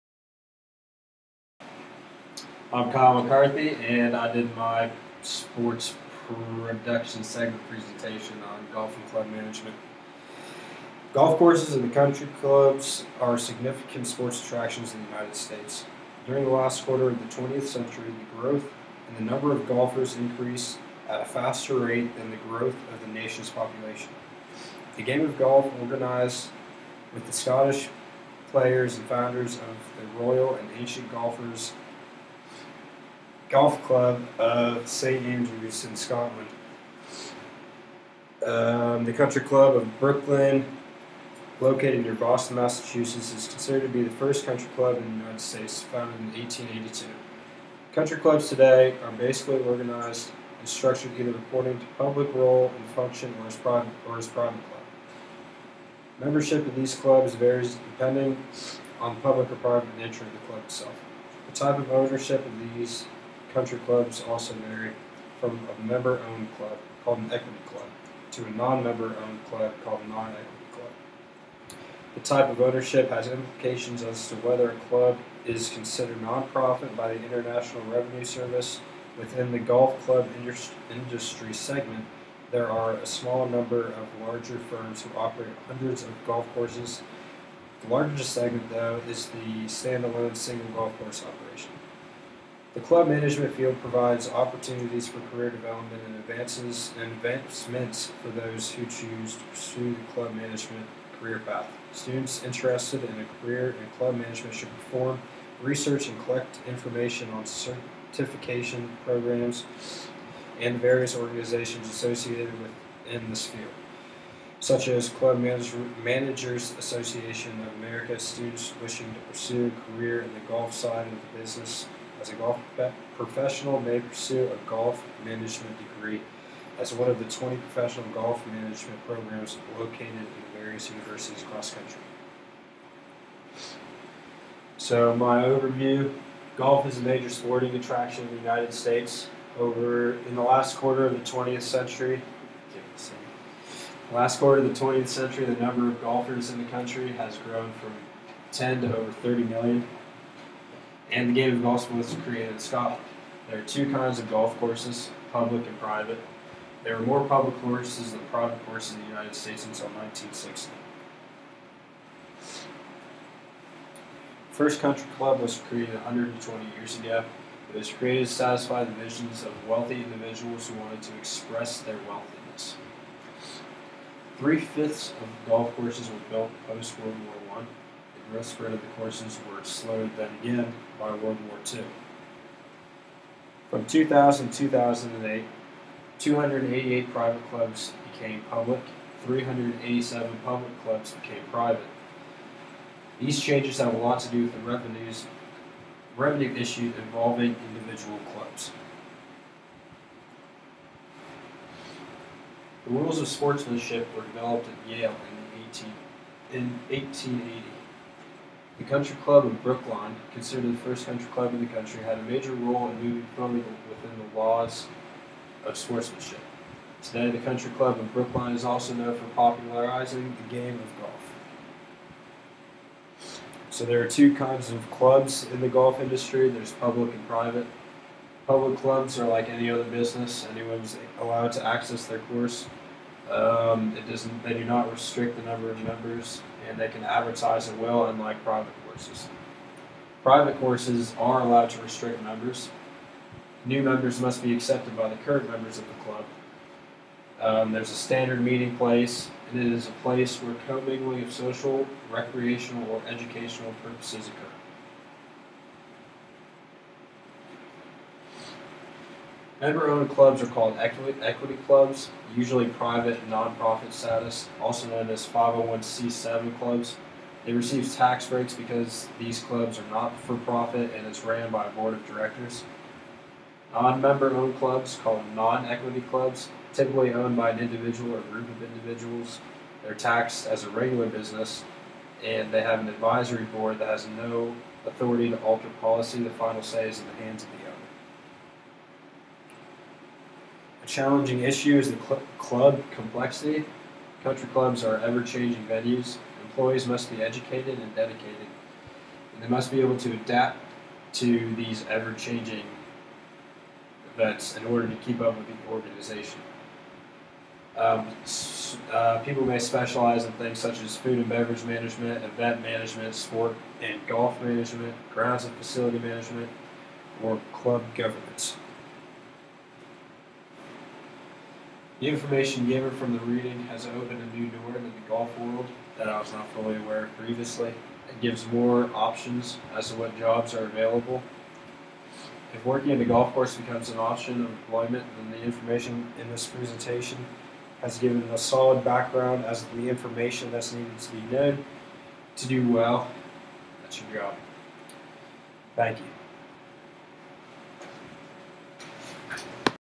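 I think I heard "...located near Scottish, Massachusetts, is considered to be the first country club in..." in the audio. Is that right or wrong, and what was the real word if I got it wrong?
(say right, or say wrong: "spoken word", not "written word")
wrong: "Boston", not "Scottish".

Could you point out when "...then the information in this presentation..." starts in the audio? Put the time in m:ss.
5:35.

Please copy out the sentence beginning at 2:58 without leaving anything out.
The rest of the courses were slowed then again by World War II.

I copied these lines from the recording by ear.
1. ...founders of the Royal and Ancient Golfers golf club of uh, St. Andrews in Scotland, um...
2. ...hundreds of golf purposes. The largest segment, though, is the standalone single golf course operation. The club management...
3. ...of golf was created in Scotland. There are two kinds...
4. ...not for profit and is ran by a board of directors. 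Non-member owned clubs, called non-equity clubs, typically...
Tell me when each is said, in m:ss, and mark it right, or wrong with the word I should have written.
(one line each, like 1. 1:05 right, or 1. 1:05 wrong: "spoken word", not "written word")
1. 0:29 right
2. 1:25 wrong: "courses", not "purposes"
3. 2:31 right
4. 4:29 right.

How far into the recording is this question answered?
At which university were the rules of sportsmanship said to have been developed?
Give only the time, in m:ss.
3:24.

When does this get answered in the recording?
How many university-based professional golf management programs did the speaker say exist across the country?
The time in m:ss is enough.
2:07.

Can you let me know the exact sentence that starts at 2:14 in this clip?
So my overview, golf is a major sporting attraction in the United States.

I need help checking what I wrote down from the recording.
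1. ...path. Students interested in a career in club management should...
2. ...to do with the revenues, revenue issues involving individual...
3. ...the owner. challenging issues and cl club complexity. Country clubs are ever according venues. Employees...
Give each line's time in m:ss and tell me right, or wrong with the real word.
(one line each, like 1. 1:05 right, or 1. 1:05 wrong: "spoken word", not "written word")
1. 1:41 right
2. 3:14 right
3. 4:47 wrong: "changing", not "according".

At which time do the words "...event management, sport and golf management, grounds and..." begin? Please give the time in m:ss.
5:12.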